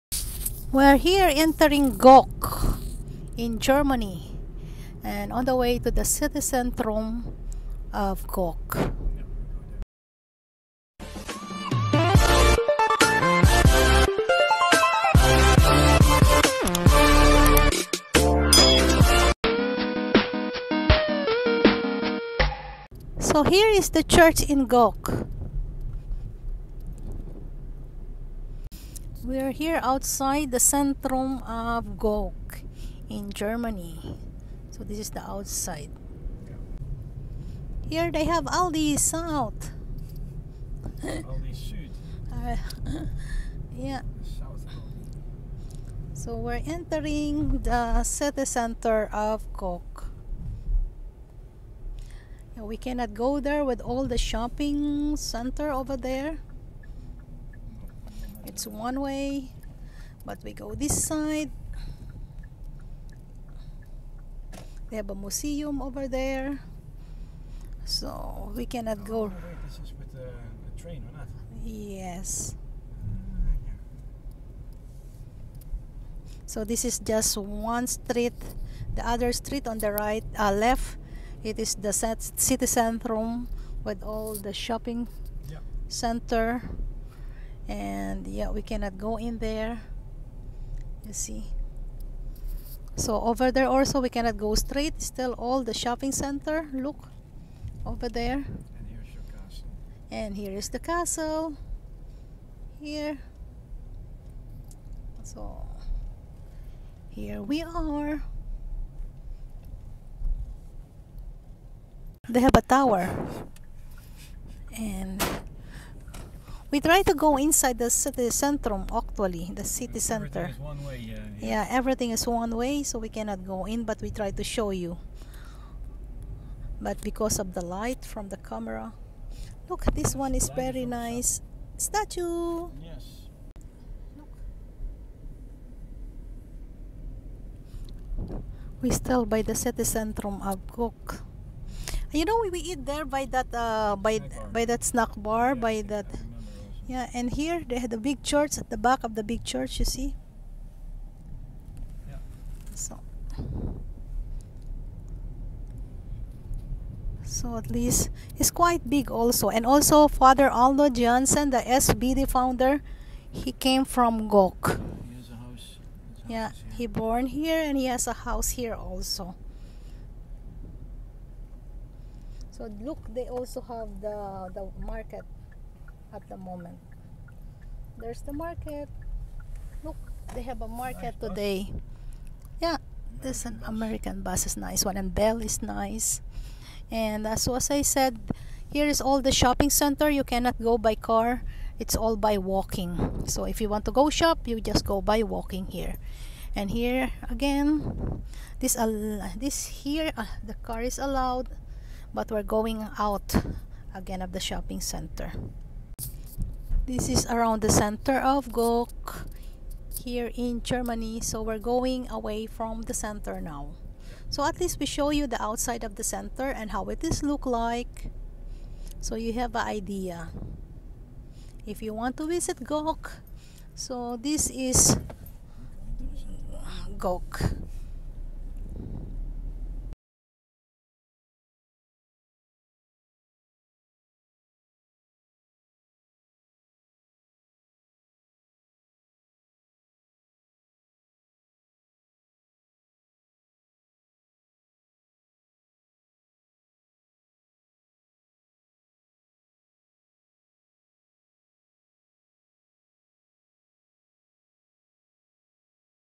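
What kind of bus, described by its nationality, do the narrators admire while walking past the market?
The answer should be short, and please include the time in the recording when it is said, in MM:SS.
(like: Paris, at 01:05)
American bus, at 03:03.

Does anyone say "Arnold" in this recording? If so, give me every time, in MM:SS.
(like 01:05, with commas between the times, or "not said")
02:40.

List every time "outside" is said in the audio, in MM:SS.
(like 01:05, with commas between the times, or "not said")
00:29, 00:35, 03:35.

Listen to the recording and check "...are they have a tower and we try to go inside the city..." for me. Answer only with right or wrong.
right.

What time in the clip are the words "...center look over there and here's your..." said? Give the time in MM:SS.
01:36.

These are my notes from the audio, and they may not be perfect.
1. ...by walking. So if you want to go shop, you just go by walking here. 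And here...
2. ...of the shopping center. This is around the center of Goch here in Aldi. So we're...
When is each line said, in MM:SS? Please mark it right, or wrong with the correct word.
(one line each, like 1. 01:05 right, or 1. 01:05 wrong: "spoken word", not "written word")
1. 03:12 right
2. 03:24 wrong: "Germany", not "Aldi".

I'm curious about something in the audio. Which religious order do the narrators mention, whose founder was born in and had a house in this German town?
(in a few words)
SVD.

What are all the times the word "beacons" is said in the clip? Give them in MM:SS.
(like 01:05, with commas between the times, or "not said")
not said.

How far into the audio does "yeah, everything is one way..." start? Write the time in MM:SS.
02:01.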